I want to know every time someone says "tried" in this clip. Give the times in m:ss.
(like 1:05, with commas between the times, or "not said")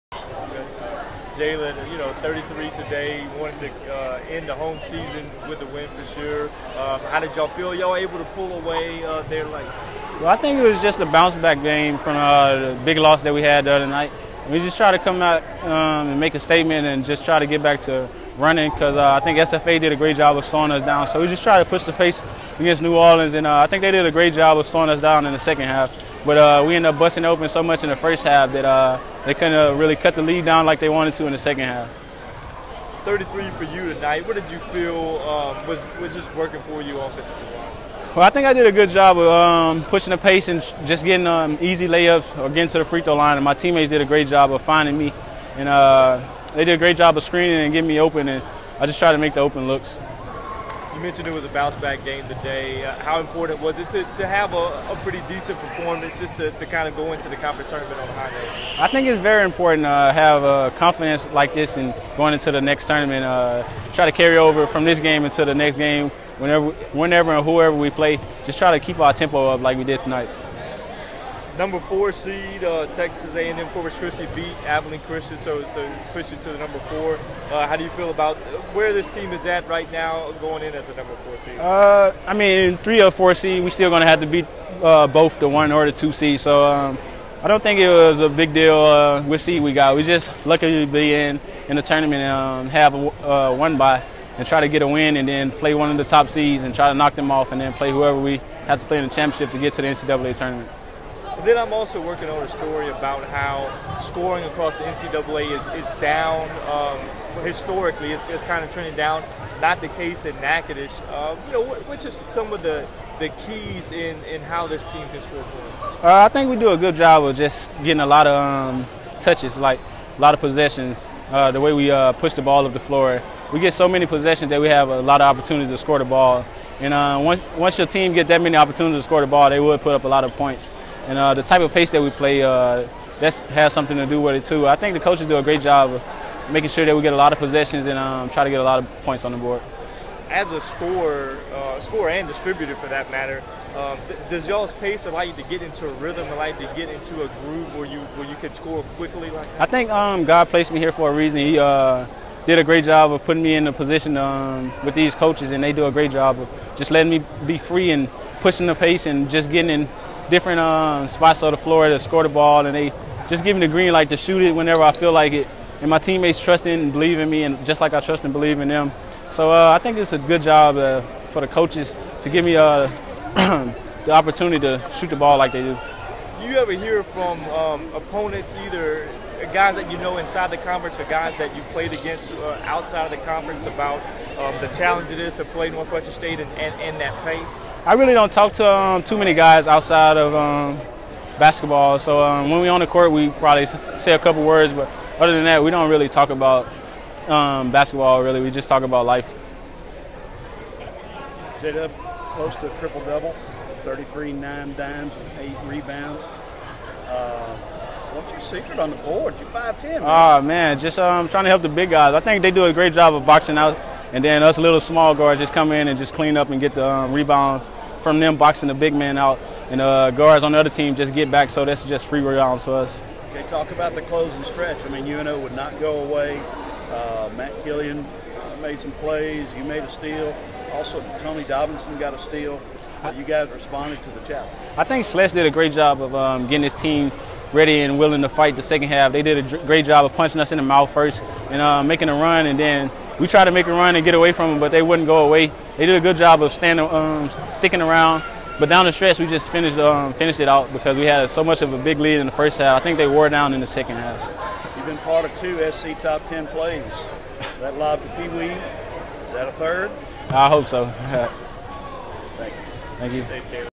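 0:48, 4:03.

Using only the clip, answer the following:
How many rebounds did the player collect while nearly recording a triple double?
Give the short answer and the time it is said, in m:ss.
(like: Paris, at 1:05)
8, at 3:25.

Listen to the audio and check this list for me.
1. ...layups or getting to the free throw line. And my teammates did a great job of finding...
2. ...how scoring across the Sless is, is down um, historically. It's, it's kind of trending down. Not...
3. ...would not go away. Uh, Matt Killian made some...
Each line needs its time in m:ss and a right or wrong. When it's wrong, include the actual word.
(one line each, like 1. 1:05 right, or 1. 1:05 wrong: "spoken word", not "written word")
1. 0:41 right
2. 1:43 wrong: "NCAA", not "Sless"
3. 3:45 right.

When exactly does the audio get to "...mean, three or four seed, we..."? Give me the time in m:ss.
1:22.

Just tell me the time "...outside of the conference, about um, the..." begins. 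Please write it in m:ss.
3:02.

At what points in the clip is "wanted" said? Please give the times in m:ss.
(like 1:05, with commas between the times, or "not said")
0:03, 0:30.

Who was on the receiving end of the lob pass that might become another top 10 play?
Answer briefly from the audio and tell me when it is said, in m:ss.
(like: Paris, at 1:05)
Pee Wee, at 4:18.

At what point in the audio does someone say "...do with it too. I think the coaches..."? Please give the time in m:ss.
2:14.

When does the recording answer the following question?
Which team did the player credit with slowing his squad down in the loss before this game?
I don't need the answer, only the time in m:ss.
0:19.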